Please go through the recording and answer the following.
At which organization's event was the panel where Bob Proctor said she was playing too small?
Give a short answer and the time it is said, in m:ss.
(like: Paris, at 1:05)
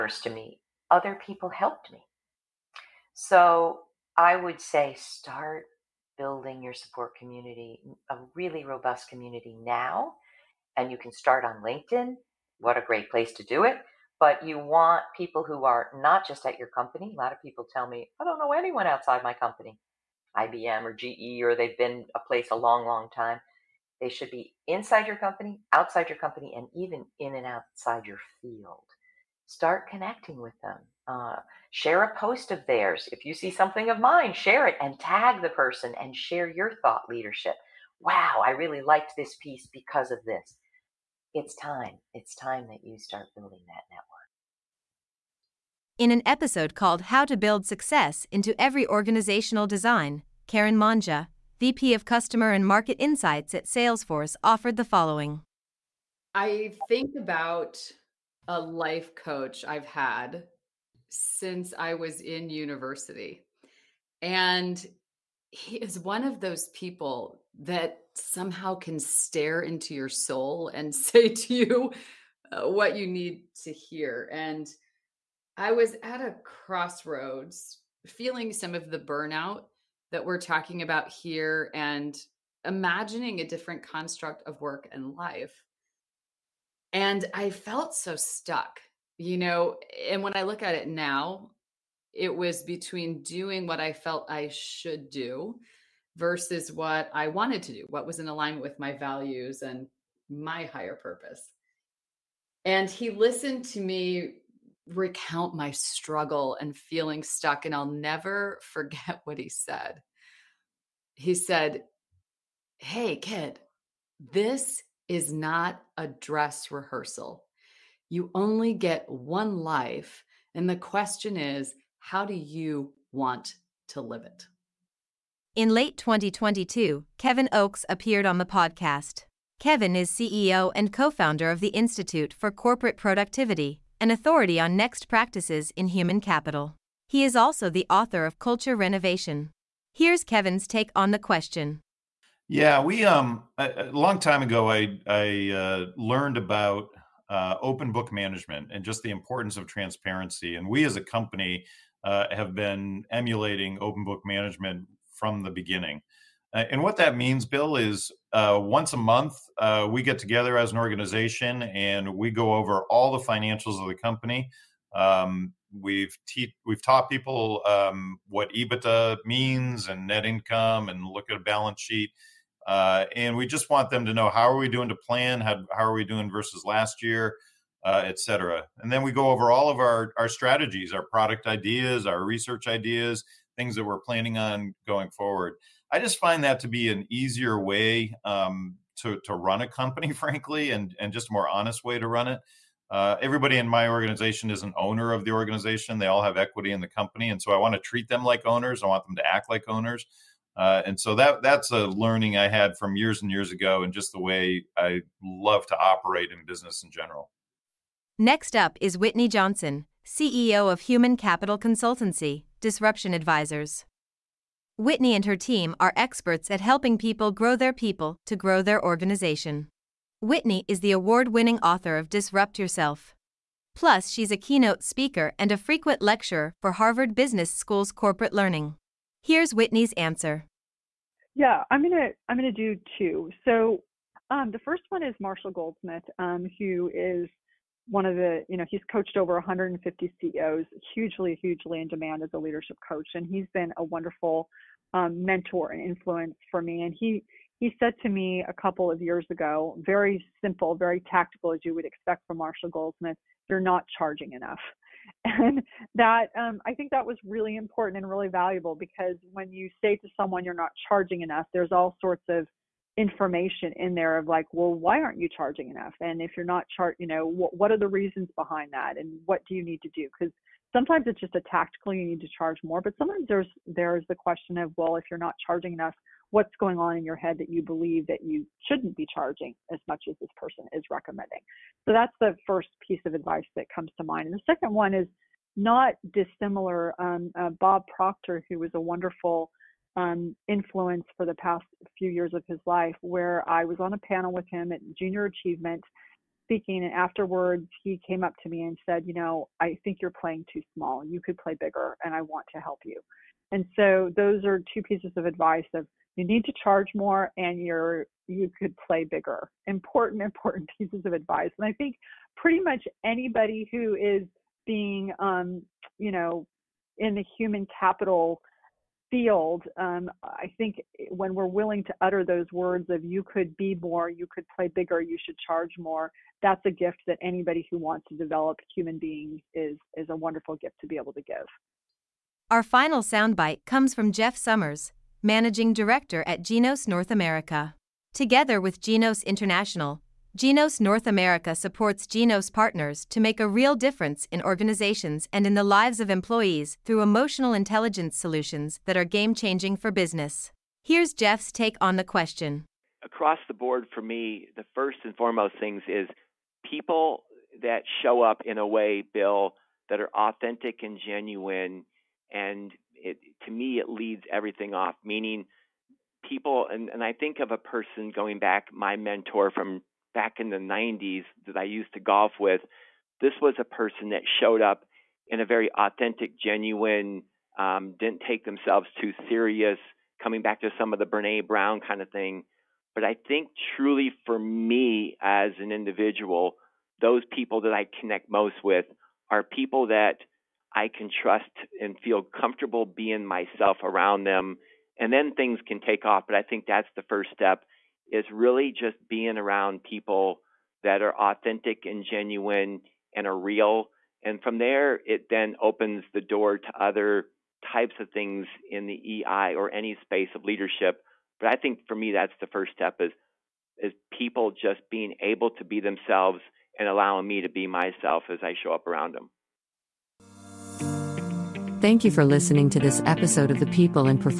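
Junior Achievement, at 4:54.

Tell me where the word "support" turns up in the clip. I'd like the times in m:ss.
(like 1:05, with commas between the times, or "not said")
0:06, 5:41.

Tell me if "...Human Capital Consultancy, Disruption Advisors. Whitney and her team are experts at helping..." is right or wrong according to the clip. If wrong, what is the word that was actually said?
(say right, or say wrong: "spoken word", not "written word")
right.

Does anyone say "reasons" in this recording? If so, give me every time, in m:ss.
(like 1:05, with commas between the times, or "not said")
4:27.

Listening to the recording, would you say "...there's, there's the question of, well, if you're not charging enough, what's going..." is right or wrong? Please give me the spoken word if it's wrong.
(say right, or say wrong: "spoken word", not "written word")
right.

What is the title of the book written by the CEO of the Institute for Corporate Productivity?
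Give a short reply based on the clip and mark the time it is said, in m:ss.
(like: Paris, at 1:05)
Culture Renovation, at 2:18.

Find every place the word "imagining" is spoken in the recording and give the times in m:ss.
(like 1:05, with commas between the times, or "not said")
1:22.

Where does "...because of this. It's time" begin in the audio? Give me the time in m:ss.
0:39.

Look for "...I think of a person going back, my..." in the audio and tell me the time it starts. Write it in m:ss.
6:07.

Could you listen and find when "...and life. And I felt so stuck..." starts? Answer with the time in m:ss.
1:24.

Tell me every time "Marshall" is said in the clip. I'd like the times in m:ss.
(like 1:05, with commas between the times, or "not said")
3:55, 4:12.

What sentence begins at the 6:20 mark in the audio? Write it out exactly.
Coming back to some of the Brene Brown kind of thing.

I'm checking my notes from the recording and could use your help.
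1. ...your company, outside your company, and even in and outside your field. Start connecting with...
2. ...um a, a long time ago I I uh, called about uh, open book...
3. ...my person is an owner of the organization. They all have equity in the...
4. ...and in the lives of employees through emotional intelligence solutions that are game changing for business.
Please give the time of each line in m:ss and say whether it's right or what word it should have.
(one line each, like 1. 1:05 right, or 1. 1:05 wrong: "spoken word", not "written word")
1. 0:25 right
2. 2:23 wrong: "learned", not "called"
3. 3:13 wrong: "organization", not "person"
4. 5:45 right.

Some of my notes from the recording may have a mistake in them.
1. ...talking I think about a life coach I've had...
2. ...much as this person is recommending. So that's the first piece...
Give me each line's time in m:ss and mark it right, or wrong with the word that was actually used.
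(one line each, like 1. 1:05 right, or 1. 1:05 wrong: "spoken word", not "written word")
1. 0:54 wrong: "following", not "talking"
2. 4:39 right.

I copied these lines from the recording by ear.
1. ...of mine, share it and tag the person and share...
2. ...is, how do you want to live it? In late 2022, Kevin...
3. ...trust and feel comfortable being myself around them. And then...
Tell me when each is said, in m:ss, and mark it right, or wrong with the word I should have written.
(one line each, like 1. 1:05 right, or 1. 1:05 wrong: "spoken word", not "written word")
1. 0:33 right
2. 2:01 right
3. 6:31 right.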